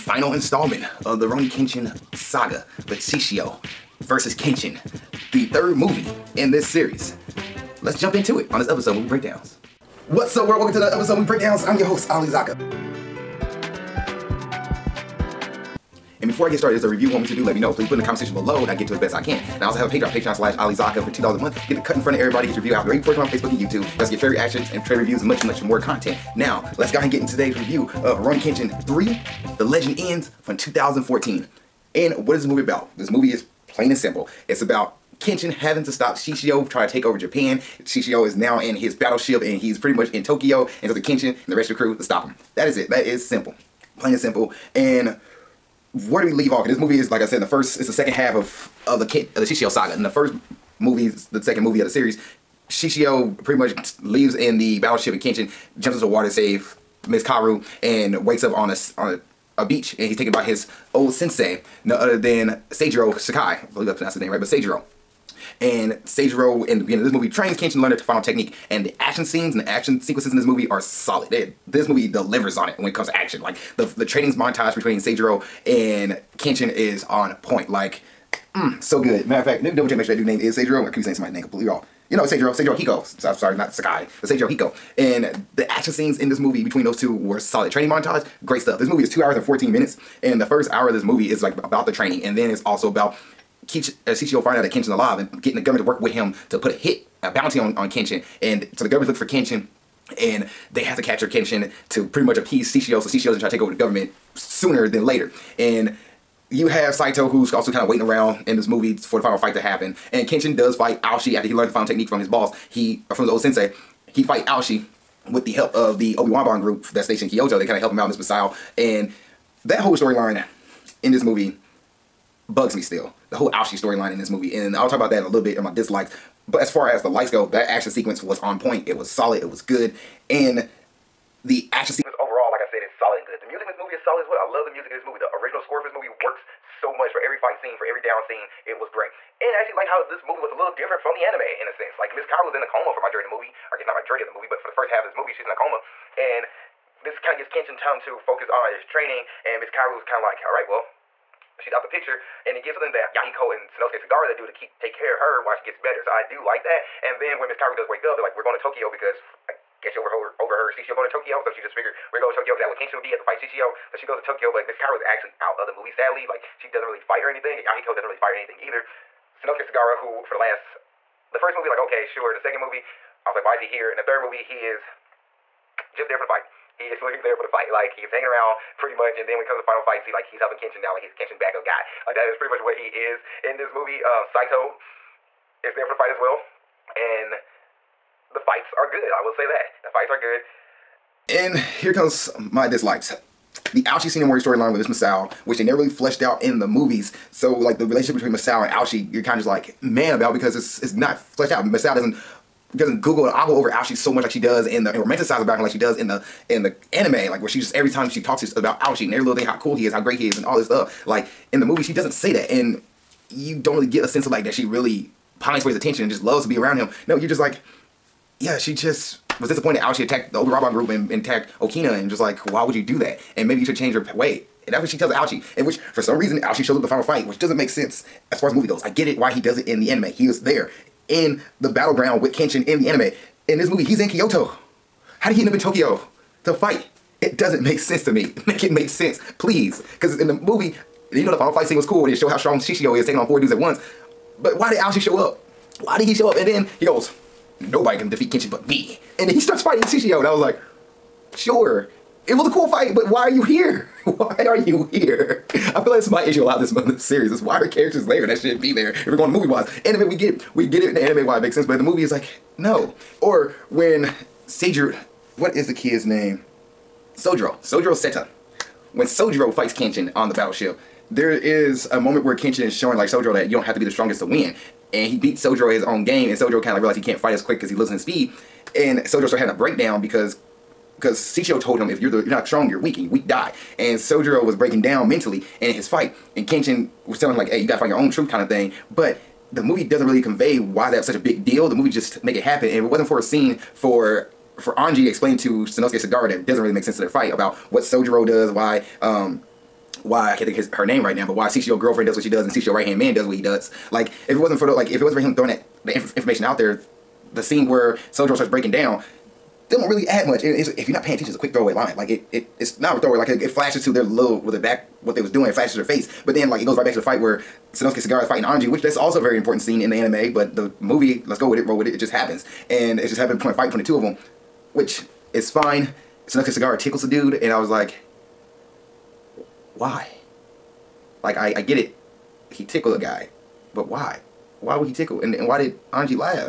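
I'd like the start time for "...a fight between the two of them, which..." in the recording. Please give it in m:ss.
5:23.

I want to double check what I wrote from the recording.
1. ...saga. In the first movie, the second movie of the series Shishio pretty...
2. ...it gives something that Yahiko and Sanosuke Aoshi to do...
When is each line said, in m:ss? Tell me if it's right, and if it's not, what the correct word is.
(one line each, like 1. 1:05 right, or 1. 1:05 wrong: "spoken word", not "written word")
1. 0:49 right
2. 2:32 wrong: "Sagara", not "Aoshi".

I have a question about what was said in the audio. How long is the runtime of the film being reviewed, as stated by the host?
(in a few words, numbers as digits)
2 hours 14 minutes.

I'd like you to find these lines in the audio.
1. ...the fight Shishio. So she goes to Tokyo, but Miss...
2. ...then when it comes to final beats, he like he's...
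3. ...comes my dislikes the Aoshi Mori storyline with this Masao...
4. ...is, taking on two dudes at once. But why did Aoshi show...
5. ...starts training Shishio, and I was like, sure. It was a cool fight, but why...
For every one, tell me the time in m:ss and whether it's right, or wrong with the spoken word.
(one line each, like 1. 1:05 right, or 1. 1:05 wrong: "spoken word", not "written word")
1. 2:43 right
2. 2:59 wrong: "fights", not "beats"
3. 3:11 right
4. 4:02 wrong: "four", not "two"
5. 4:09 wrong: "fighting", not "training".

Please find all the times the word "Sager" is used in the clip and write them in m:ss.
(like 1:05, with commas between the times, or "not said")
4:24.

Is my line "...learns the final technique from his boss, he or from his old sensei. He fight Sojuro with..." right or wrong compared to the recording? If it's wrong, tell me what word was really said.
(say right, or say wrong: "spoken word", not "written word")
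wrong: "Aoshi", not "Sojuro".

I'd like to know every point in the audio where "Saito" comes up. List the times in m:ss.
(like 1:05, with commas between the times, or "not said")
1:46, 3:04.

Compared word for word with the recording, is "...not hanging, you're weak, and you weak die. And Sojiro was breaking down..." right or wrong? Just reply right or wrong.
wrong.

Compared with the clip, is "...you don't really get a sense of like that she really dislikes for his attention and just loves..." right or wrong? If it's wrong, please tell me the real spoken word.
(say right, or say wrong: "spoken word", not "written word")
wrong: "pines", not "dislikes".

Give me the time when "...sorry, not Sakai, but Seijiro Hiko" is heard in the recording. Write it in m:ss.
1:23.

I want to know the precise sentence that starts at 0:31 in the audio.
And what is this movie about?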